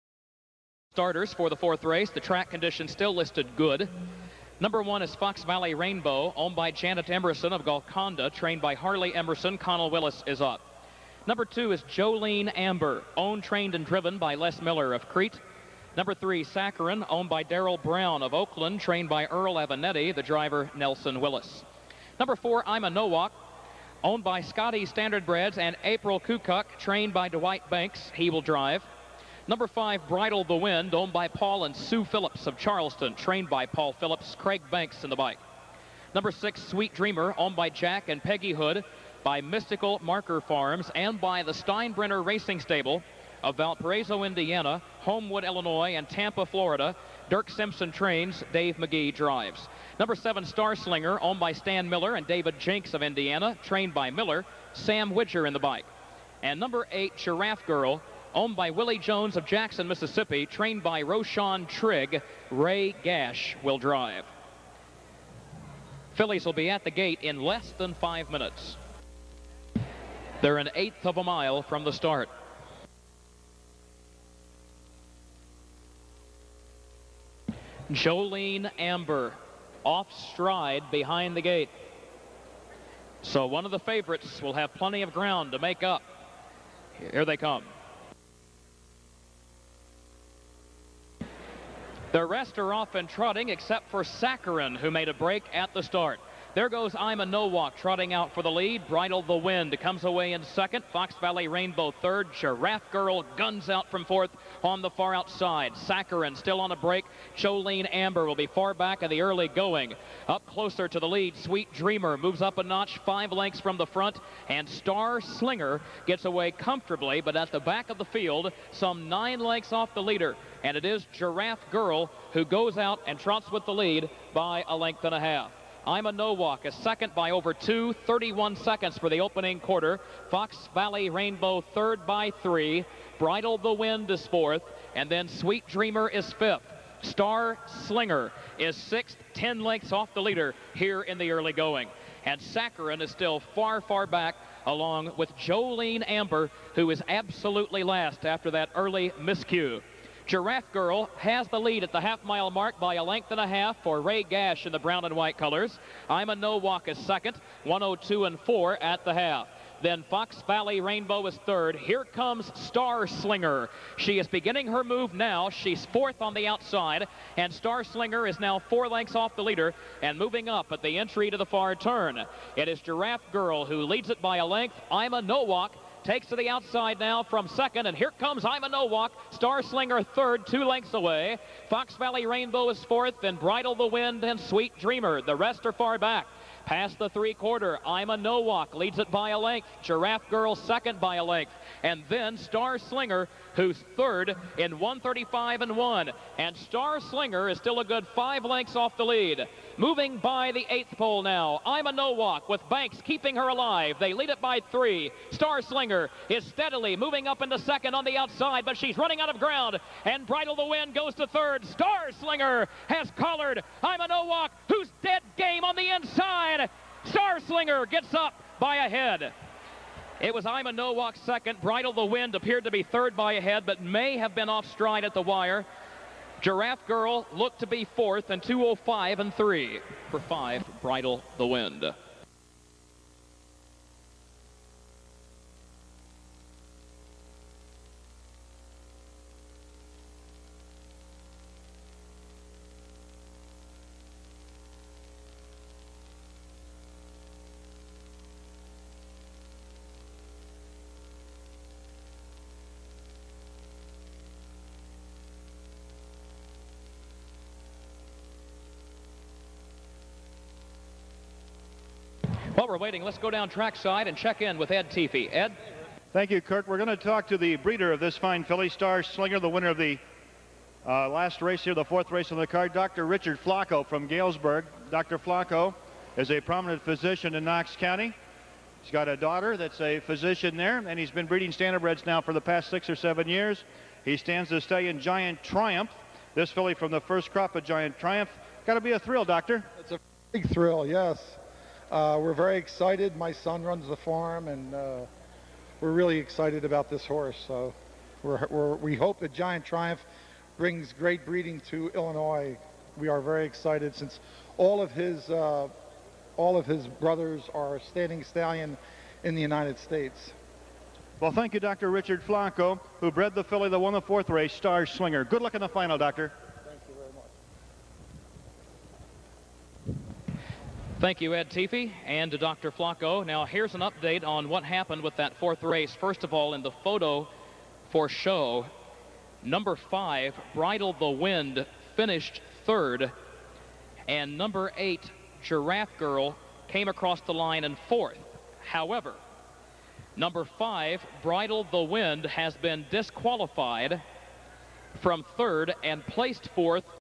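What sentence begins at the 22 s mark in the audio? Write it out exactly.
Number four, Ima Nowak, owned by Scotty Standardbreds and April Kukuk, trained by Dwight Banks.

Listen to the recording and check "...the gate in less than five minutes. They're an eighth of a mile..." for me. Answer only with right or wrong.
right.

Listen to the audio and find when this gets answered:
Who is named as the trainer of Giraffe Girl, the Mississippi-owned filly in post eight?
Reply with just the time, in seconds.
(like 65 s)
61 s.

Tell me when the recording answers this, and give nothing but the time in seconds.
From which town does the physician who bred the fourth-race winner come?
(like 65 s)
274 s.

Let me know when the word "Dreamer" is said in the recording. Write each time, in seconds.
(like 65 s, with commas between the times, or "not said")
36 s, 111 s, 135 s, 184 s.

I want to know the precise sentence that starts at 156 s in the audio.
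Ima Nowak is second, 102 and 4 at the half.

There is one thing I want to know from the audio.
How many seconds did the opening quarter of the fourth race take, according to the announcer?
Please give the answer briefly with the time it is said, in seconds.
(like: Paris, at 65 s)
31, at 128 s.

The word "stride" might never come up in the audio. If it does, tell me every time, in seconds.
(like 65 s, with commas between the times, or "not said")
80 s, 224 s.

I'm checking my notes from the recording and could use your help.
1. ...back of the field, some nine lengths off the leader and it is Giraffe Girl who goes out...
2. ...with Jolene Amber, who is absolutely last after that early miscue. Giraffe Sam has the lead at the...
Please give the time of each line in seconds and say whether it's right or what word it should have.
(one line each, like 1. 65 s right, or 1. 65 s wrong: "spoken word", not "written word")
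1. 117 s right
2. 145 s wrong: "Girl", not "Sam".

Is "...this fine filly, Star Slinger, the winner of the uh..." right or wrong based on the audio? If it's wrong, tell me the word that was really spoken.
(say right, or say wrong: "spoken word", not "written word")
right.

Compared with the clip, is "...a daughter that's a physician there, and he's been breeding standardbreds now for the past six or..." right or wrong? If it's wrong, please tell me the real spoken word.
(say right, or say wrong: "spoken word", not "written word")
right.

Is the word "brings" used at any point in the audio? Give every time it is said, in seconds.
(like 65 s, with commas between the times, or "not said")
300 s.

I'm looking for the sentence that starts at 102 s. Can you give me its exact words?
Giraffe Girl guns out from fourth on the far outside.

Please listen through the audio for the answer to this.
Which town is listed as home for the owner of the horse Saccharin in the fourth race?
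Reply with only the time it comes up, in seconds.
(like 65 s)
18 s.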